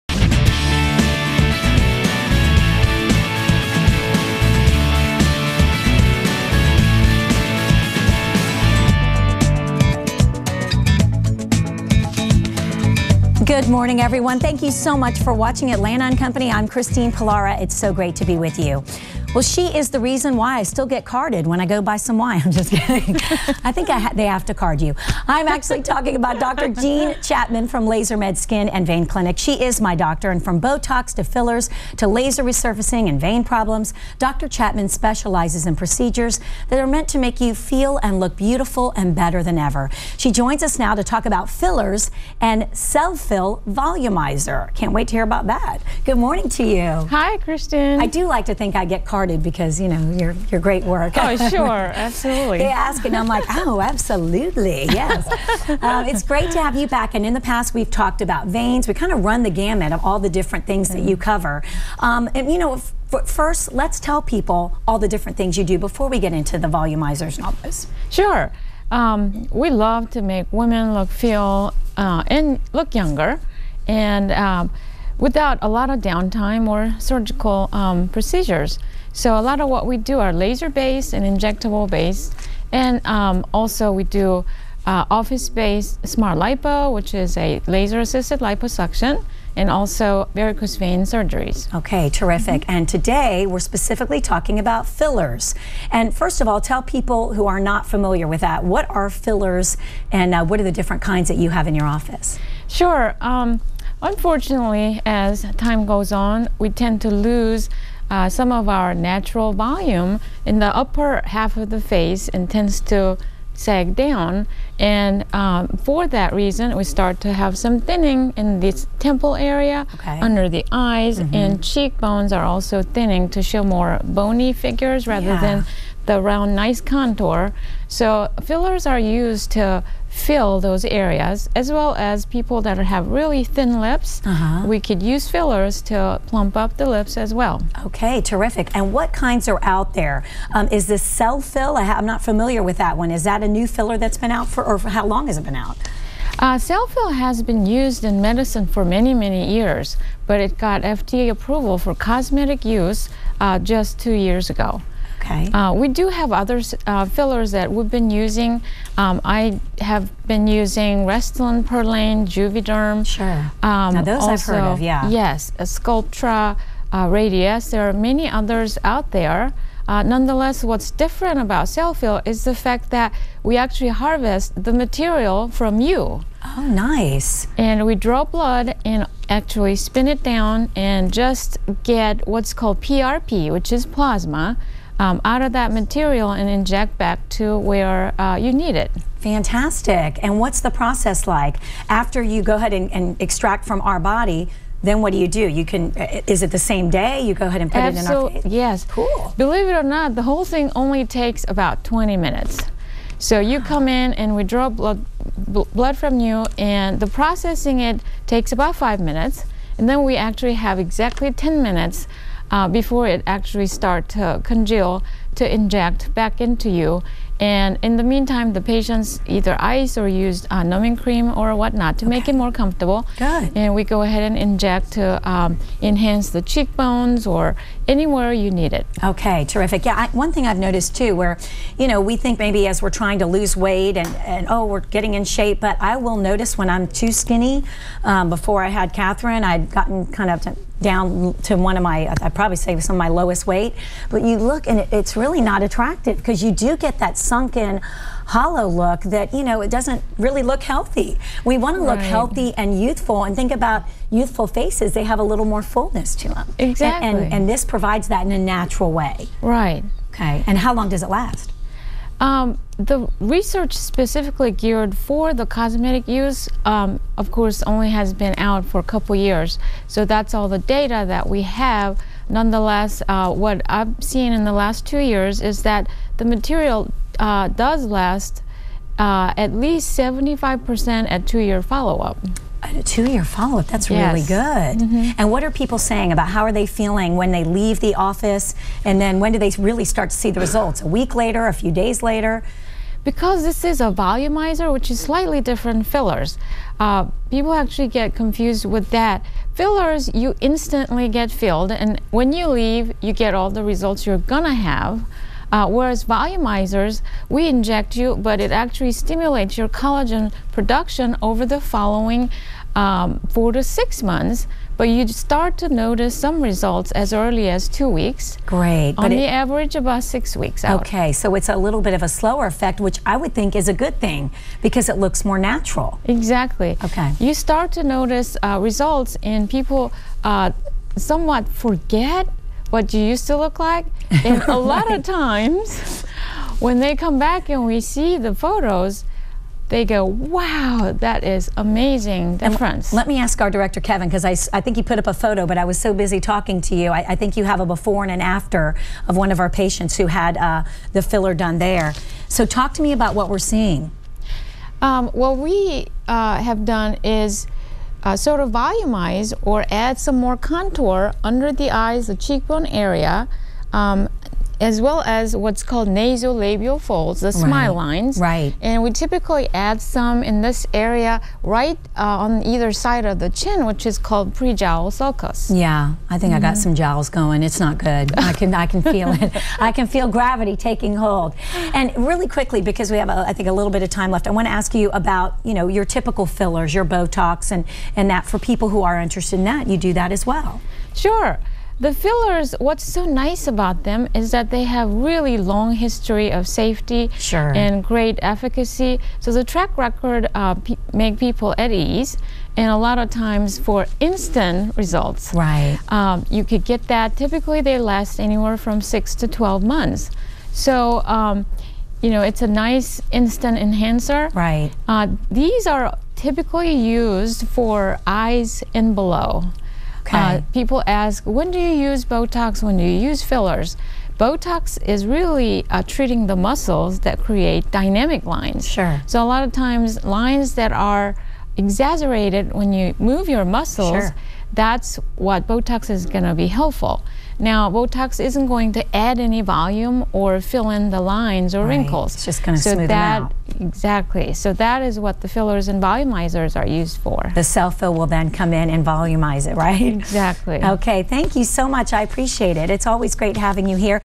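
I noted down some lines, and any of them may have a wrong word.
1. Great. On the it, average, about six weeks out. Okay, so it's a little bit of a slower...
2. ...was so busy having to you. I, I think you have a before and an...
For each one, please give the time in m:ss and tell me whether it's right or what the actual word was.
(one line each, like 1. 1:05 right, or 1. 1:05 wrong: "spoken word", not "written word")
1. 5:18 right
2. 5:45 wrong: "talking", not "having".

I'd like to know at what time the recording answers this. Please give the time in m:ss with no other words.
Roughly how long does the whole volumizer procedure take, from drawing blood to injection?
3:21.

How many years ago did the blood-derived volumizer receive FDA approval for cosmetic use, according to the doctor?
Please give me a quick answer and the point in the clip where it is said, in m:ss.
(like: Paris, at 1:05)
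2 years, at 2:33.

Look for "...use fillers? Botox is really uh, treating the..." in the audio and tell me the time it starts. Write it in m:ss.
7:03.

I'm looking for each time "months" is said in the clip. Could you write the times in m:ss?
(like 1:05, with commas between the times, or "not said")
5:14, 6:49.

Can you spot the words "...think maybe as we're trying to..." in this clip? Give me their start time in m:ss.
3:52.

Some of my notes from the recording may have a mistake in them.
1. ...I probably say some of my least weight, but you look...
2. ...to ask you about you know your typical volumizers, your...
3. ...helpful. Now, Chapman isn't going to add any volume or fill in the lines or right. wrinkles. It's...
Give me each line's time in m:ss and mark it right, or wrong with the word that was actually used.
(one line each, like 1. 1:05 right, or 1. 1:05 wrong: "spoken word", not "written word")
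1. 4:02 wrong: "lowest", not "least"
2. 6:24 wrong: "fillers", not "volumizers"
3. 7:16 wrong: "Botox", not "Chapman".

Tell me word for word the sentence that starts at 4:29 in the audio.
So that's all the data that we have.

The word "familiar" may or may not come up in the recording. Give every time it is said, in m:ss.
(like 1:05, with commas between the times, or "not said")
1:37, 2:22.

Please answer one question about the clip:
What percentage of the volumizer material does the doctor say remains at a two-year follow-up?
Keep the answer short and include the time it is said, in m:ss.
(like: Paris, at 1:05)
75%, at 4:39.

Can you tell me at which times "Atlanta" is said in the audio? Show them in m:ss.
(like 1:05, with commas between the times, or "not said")
0:15.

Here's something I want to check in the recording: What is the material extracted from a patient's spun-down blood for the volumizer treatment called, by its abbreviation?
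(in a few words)
PRP.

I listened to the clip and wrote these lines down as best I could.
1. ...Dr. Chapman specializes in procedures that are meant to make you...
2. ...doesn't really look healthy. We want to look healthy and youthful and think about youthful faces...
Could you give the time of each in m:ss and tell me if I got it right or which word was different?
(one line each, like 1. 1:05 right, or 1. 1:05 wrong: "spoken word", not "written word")
1. 0:34 right
2. 4:09 right.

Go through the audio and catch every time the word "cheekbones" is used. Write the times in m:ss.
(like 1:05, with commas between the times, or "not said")
2:01, 3:46, 6:02.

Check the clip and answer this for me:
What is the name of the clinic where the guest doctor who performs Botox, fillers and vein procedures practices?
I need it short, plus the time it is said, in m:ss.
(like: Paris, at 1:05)
LaserMed Skin and Vein Clinic, at 0:27.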